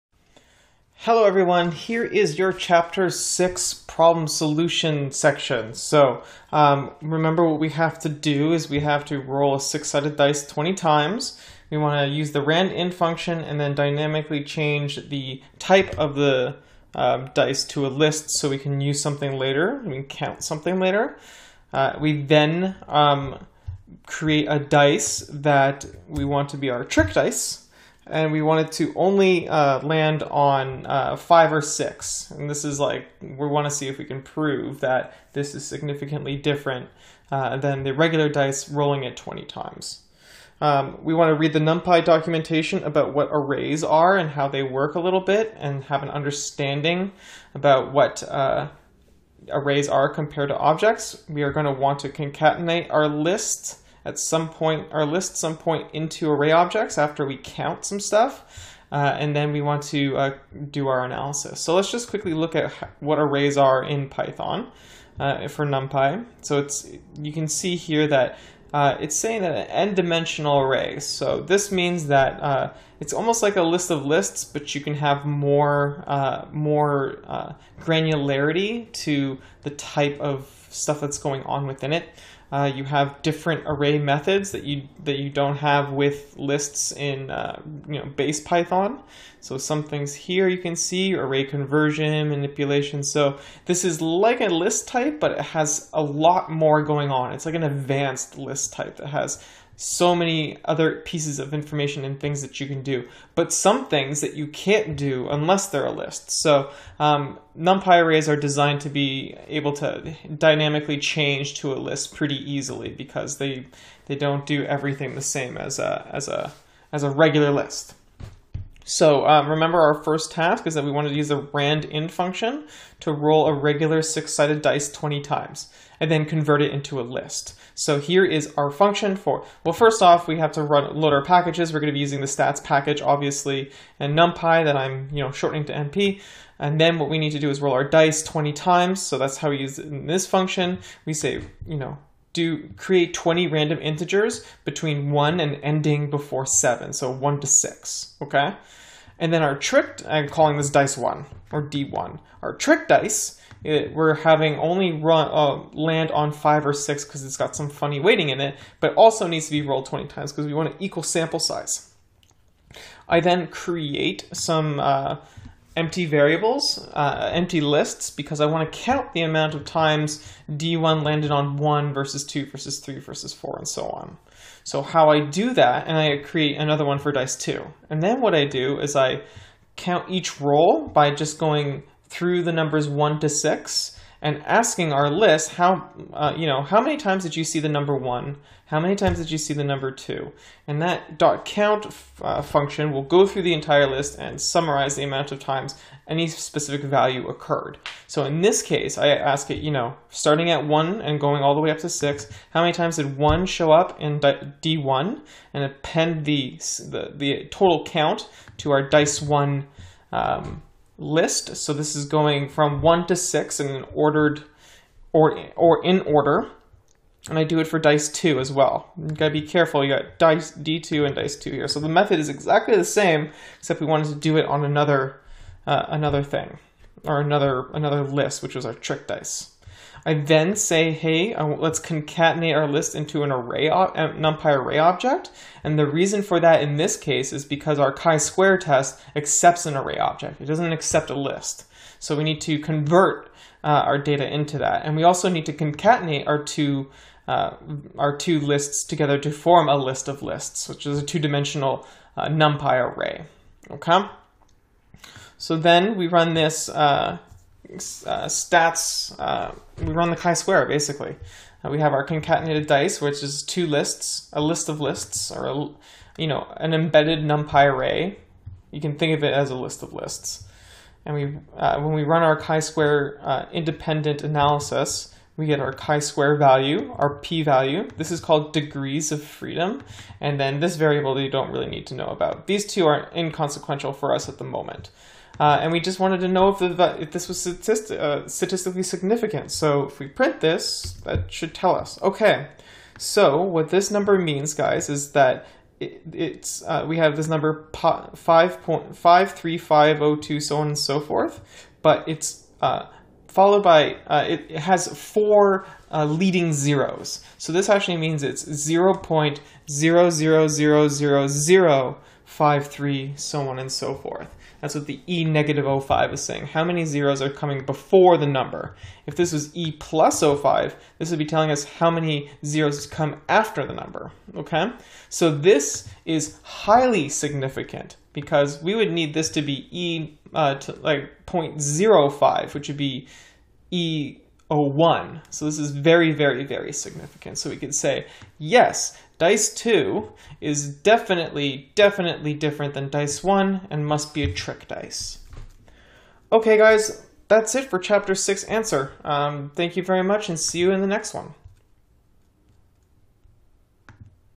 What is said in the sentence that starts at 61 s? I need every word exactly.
So let's just quickly look at what arrays are in Python uh, for NumPy.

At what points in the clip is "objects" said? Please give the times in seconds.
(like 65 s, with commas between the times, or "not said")
50 s, 56 s, 234 s, 239 s.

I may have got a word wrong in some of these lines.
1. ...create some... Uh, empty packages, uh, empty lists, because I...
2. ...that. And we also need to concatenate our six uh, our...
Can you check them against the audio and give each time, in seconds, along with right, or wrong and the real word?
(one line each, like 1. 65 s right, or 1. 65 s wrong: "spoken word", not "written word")
1. 163 s wrong: "variables", not "packages"
2. 244 s wrong: "two", not "six".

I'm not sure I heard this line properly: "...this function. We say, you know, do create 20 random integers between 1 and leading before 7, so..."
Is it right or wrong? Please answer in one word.
wrong.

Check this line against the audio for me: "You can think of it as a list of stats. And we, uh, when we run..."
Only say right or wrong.
wrong.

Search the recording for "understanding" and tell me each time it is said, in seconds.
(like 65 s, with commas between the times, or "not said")
46 s.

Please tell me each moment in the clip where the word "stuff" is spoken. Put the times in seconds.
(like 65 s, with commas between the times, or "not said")
57 s, 80 s.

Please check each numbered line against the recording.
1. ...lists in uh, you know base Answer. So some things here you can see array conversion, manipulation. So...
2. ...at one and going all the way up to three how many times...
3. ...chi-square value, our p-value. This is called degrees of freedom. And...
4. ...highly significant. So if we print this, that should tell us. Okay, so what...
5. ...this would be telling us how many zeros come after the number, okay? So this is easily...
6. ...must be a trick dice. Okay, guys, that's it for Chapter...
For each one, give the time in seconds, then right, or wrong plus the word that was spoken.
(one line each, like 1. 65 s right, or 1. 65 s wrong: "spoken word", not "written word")
1. 86 s wrong: "Python", not "Answer"
2. 200 s wrong: "six", not "three"
3. 275 s right
4. 288 s wrong: "statistically", not "highly"
5. 320 s wrong: "highly", not "easily"
6. 343 s right.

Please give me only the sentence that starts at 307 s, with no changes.
So this actually means it's 0.00000 5, 3, so on and so forth.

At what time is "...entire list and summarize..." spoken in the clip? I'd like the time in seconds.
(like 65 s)
193 s.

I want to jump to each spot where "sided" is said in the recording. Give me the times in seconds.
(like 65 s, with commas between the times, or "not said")
9 s, 124 s.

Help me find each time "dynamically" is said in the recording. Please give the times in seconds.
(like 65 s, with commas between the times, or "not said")
13 s, 110 s.